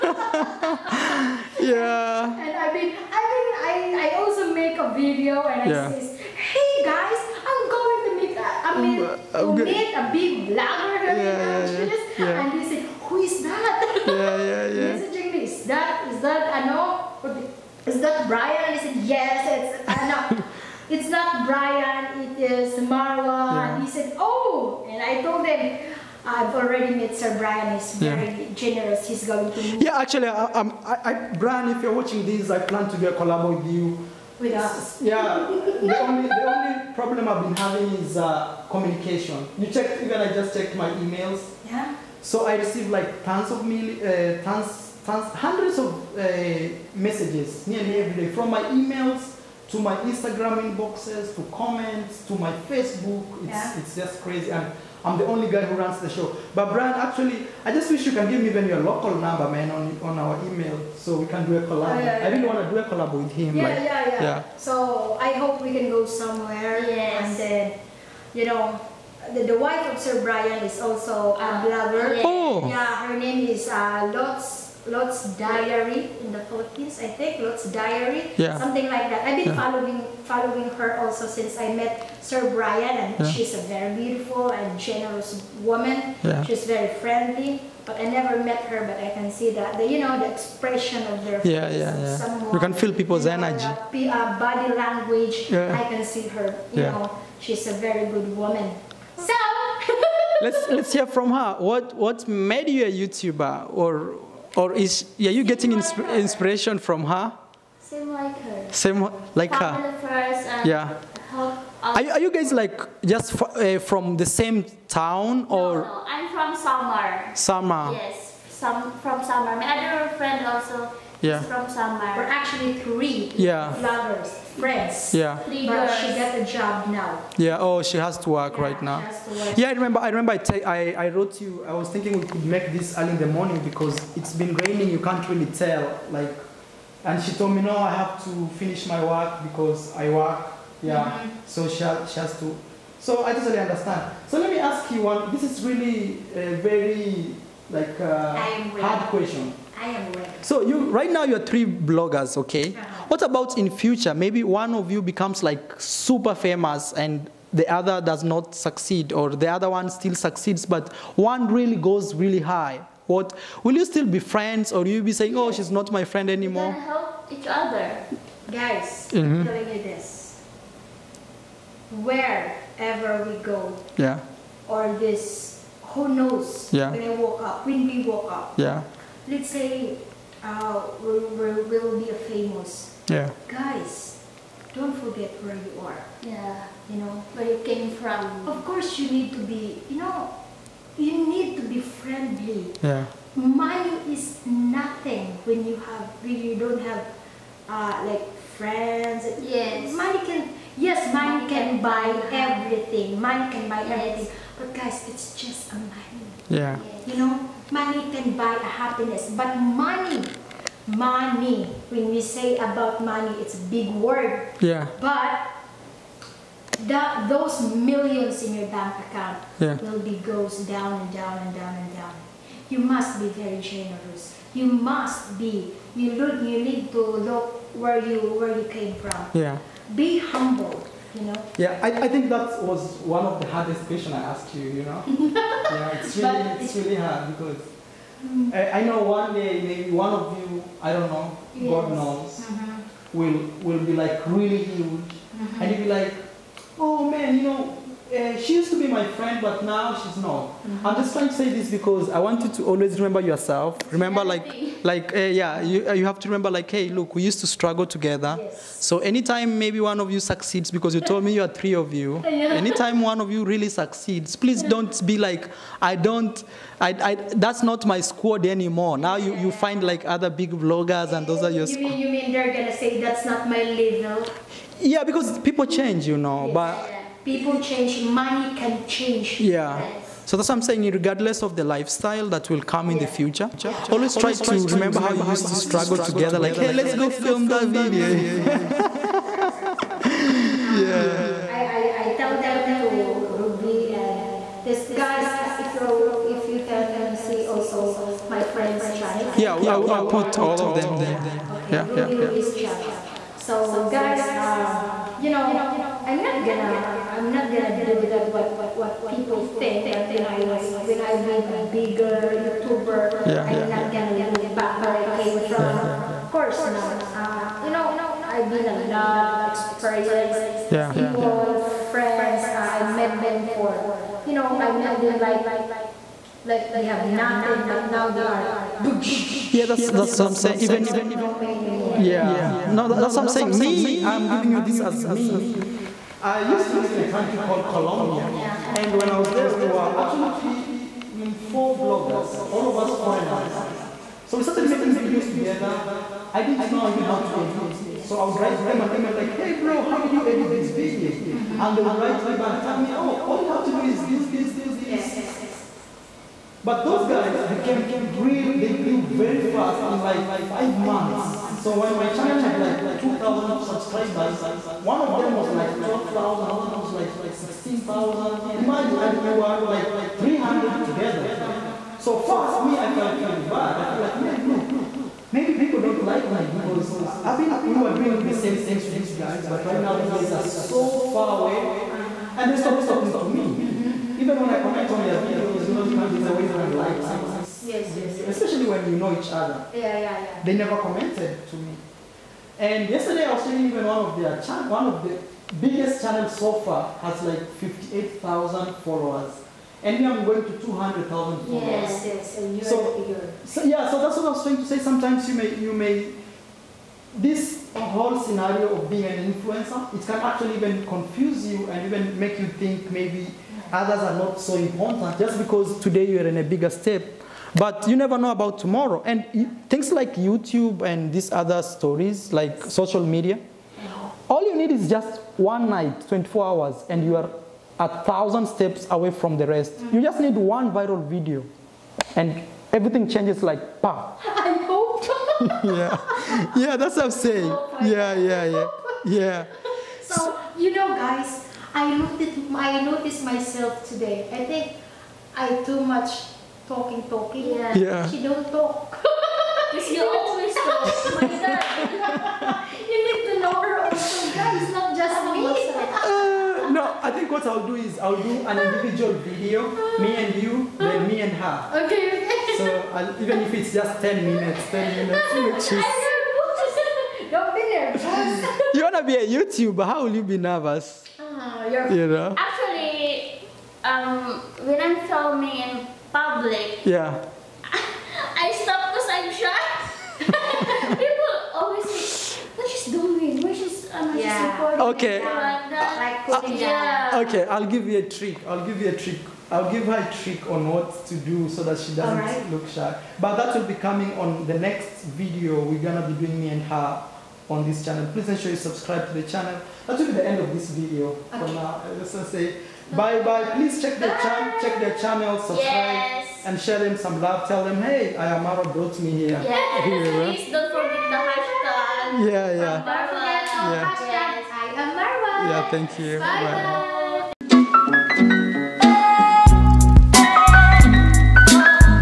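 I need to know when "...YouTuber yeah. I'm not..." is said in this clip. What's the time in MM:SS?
05:12.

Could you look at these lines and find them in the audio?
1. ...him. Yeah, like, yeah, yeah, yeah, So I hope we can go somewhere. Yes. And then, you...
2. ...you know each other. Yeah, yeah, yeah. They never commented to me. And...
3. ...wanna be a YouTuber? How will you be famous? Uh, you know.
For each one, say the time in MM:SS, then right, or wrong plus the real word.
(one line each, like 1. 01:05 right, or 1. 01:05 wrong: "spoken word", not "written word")
1. 01:03 right
2. 06:28 right
3. 07:48 wrong: "nervous", not "famous".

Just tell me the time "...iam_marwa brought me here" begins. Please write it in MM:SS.
08:28.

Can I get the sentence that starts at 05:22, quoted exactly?
Uh, I met them for you know I met them like like they have nothing but now they are boosh.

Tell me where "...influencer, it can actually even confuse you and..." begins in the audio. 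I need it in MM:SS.
06:49.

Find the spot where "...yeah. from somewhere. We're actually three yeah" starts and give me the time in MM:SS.
02:01.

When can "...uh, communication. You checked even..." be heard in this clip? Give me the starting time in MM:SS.
00:38.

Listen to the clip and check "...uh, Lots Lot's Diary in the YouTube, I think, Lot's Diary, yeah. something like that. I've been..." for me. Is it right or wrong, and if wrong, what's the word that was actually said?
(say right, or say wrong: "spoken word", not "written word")
wrong: "Philippines", not "YouTube".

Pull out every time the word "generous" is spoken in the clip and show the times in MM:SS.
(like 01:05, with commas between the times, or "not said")
00:28, 01:24, 03:43.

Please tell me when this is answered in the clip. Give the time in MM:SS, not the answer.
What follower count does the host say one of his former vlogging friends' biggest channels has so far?
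06:37.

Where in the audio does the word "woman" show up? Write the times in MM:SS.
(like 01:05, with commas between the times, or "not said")
01:25, 01:38.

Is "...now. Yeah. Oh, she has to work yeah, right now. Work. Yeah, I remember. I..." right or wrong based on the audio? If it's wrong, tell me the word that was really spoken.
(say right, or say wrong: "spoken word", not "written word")
right.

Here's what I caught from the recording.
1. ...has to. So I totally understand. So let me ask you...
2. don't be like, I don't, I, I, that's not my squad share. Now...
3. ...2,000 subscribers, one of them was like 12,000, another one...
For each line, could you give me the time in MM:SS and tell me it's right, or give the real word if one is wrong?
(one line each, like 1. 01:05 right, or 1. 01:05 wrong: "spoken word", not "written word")
1. 02:22 right
2. 04:24 wrong: "anymore", not "share"
3. 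06:02 right.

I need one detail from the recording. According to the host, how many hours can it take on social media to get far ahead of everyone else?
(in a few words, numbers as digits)
24.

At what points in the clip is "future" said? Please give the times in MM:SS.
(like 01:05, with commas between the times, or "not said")
02:33, 04:43.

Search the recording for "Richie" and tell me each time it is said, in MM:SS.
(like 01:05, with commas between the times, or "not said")
not said.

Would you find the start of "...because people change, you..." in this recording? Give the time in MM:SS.
04:35.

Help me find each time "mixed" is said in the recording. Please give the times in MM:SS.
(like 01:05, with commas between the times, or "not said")
not said.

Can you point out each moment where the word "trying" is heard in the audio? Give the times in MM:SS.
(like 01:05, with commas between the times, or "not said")
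04:11, 06:44.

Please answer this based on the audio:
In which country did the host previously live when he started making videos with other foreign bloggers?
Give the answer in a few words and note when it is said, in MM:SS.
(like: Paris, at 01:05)
Colombia, at 05:37.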